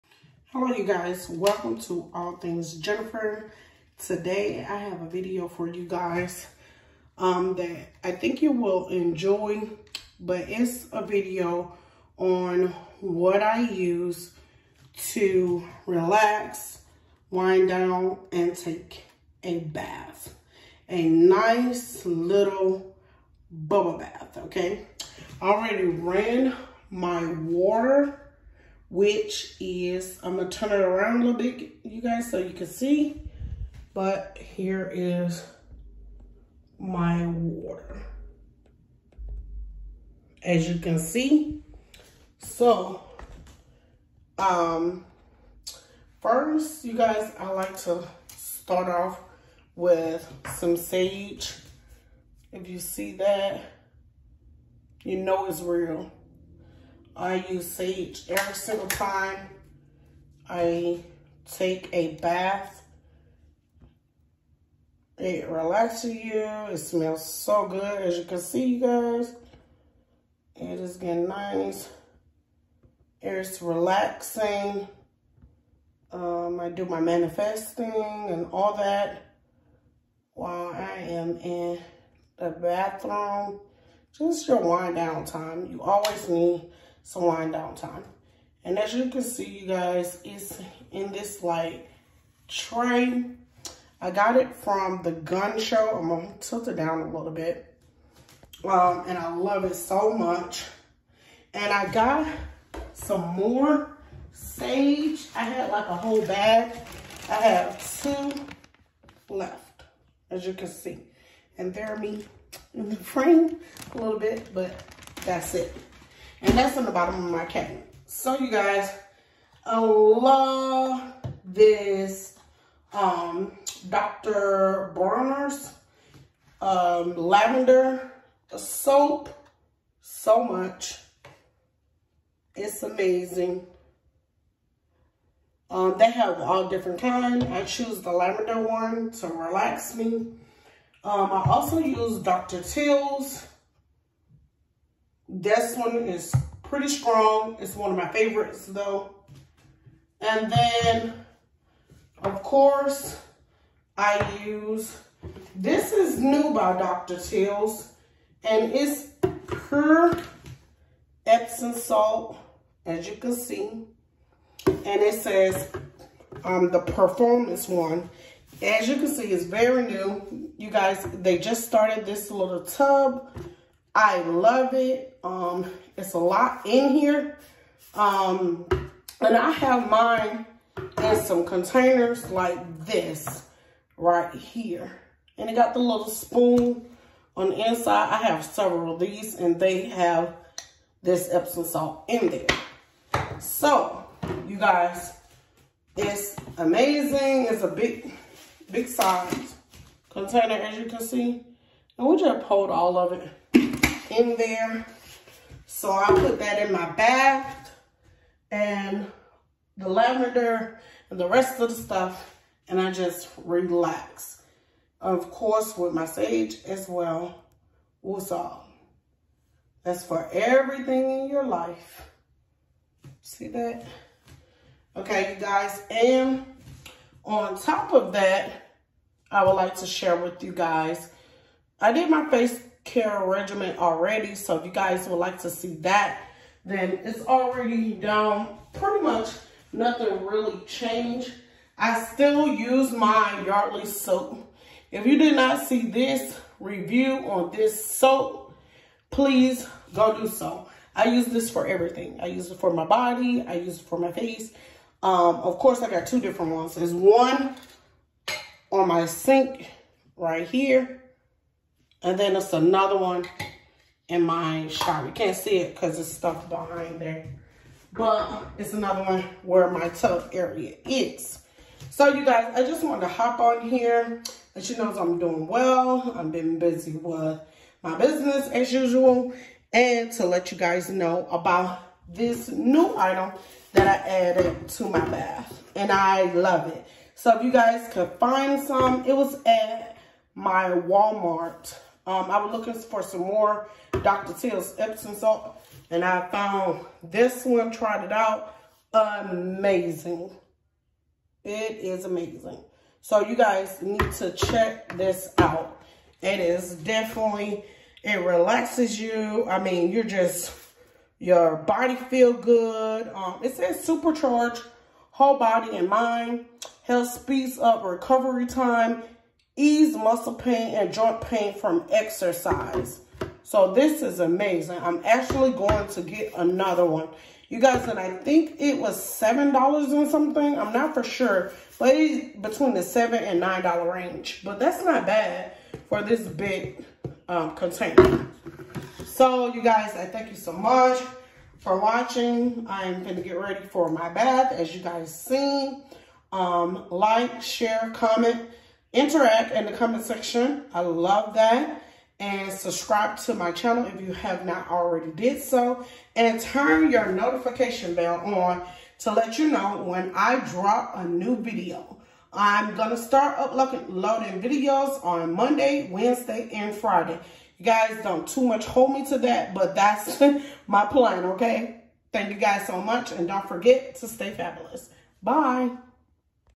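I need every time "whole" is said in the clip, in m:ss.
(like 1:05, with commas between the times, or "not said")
1:45, 5:15.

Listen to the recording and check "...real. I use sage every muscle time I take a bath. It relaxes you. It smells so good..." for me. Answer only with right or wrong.
wrong.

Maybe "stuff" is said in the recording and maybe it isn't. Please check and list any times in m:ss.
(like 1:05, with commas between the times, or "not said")
3:31, 4:26.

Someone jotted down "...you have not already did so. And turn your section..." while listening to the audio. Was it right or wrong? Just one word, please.
wrong.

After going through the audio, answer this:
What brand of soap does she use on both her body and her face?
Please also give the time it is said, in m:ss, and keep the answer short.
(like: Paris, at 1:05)
Yardley, at 4:03.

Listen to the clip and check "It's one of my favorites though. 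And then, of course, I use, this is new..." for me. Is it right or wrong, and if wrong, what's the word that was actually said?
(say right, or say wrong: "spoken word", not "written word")
right.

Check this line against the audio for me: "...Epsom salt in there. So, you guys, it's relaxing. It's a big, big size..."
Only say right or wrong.
wrong.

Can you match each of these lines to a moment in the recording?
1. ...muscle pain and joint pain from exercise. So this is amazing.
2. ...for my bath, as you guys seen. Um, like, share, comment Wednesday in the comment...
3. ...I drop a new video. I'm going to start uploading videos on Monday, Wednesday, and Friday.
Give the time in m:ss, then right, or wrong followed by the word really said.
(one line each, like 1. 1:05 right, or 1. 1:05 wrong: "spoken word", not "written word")
1. 5:19 right
2. 5:43 wrong: "Interact", not "Wednesday"
3. 6:00 right.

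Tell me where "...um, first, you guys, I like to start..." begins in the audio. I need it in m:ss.
0:44.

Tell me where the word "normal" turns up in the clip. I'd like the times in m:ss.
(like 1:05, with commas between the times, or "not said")
not said.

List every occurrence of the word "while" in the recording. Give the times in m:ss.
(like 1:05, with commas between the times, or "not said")
1:20.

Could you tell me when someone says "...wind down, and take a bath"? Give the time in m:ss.
0:17.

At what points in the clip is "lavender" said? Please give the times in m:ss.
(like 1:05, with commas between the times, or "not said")
2:07, 2:18, 3:29.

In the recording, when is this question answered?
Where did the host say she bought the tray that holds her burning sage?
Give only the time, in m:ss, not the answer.
1:35.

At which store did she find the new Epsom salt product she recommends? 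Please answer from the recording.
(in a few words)
Walmart.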